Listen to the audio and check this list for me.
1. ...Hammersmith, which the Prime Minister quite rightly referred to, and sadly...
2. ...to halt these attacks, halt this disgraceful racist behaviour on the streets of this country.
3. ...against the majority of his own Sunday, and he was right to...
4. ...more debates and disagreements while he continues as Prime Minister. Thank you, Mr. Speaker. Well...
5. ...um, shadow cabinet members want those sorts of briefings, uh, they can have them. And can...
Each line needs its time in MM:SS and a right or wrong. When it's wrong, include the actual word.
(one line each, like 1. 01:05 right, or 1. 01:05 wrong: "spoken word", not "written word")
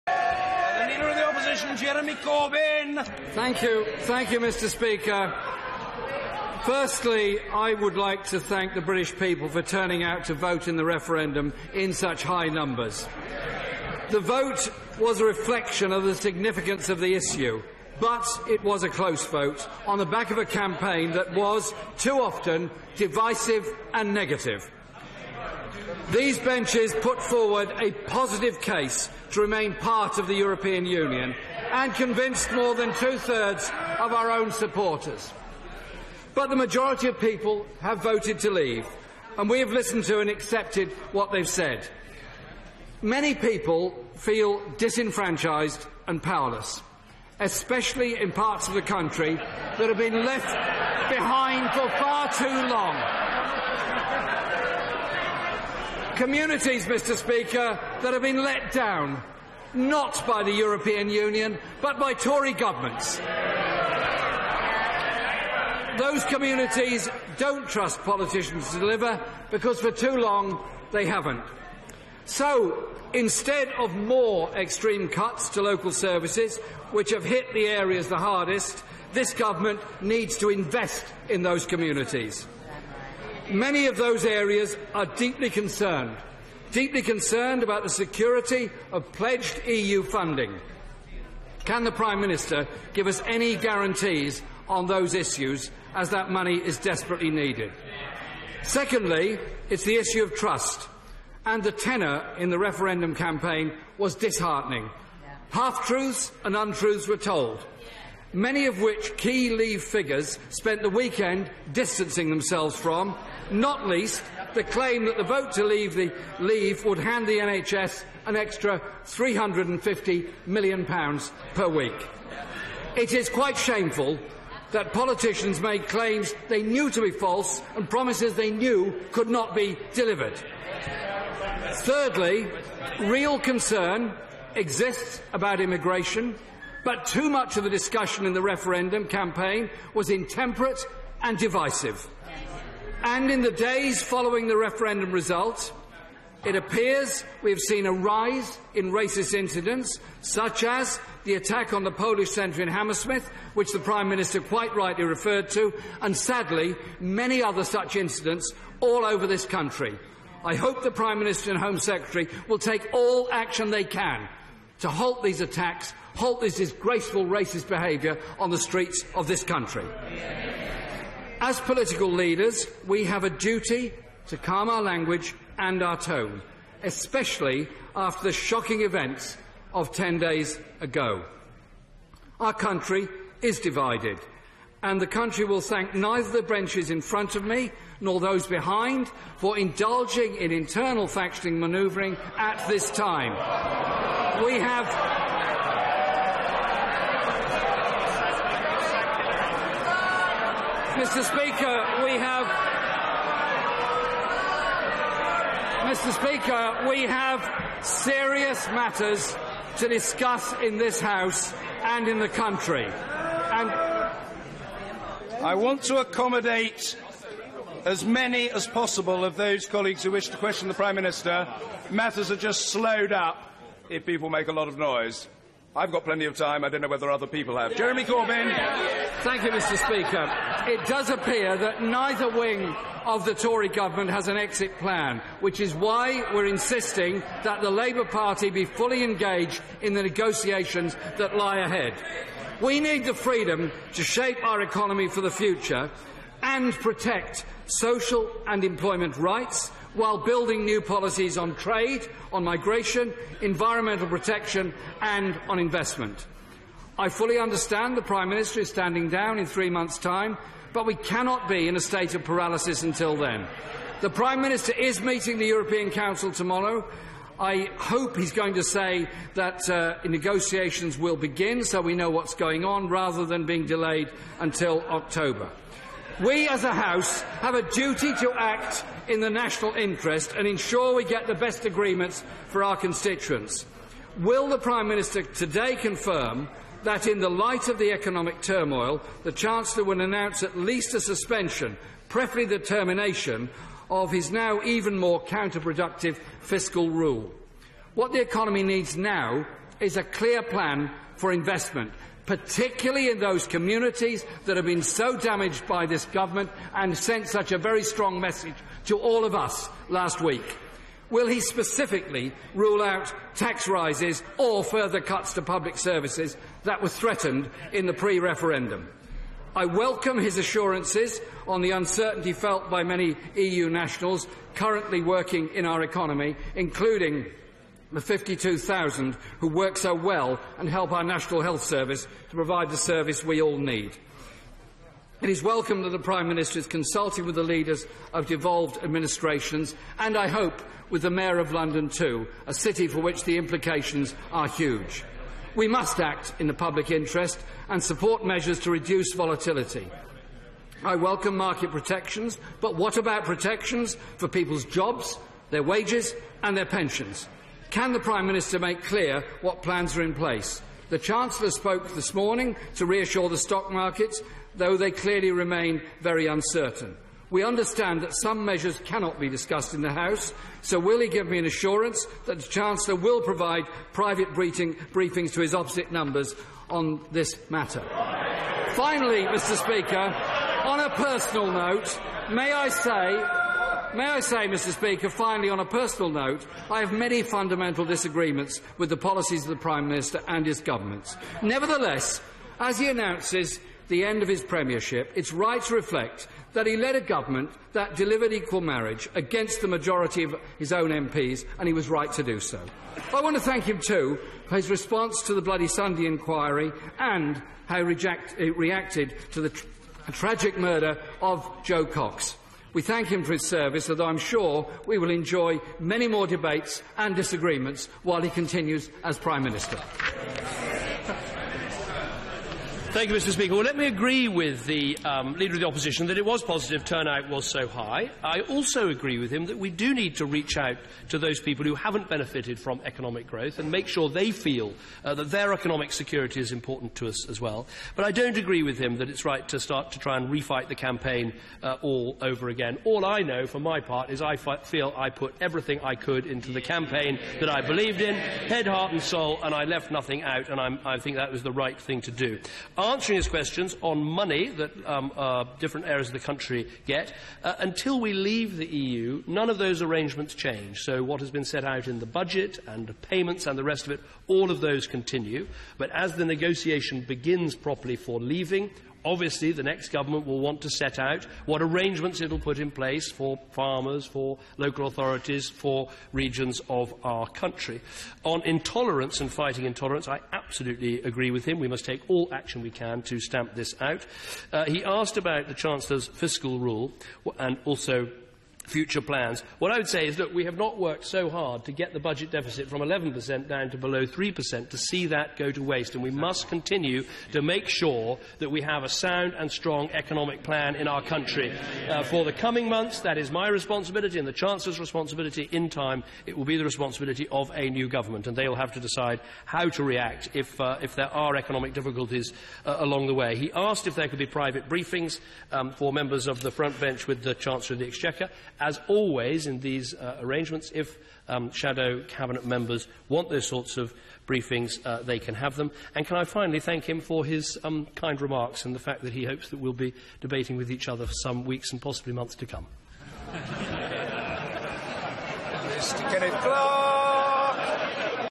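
1. 02:32 right
2. 02:44 right
3. 06:39 wrong: "MPs", not "Sunday"
4. 06:56 right
5. 08:41 right.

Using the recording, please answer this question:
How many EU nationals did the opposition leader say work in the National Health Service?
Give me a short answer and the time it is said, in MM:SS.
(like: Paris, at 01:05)
52,000, at 05:27.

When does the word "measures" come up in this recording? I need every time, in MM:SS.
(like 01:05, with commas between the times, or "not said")
05:48, 06:08.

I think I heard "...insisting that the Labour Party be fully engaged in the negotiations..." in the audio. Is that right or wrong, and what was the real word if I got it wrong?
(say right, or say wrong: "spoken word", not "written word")
right.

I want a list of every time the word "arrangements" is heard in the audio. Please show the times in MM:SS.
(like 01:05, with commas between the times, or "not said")
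07:39, 07:51, 08:40.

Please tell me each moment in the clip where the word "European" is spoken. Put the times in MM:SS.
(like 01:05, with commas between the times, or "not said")
00:30, 01:00, 04:25.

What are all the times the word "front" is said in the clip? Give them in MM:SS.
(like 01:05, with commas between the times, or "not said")
03:07, 08:36.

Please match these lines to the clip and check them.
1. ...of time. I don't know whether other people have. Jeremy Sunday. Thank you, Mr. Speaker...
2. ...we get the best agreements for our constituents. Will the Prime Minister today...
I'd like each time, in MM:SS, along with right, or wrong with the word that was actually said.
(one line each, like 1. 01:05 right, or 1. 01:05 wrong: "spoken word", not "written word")
1. 03:46 wrong: "Corbyn", not "Sunday"
2. 04:40 right.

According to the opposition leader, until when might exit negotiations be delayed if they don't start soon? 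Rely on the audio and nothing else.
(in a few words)
October.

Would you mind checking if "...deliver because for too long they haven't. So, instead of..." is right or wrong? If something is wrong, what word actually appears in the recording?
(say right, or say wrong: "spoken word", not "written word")
right.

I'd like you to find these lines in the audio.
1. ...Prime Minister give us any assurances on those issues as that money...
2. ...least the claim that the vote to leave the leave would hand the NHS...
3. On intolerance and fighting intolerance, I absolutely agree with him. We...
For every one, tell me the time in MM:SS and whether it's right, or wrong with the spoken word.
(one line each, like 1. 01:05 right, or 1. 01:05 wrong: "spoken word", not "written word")
1. 01:31 wrong: "guarantees", not "assurances"
2. 01:53 right
3. 07:58 right.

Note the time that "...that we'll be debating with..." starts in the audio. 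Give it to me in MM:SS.
08:49.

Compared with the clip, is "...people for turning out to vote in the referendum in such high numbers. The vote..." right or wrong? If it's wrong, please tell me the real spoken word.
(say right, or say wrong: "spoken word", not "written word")
right.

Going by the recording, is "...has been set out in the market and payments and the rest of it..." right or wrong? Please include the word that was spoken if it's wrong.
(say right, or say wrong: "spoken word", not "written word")
wrong: "budget", not "market".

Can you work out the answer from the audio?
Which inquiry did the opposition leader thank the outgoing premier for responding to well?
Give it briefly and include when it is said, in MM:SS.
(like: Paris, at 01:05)
Bloody Sunday inquiry, at 06:45.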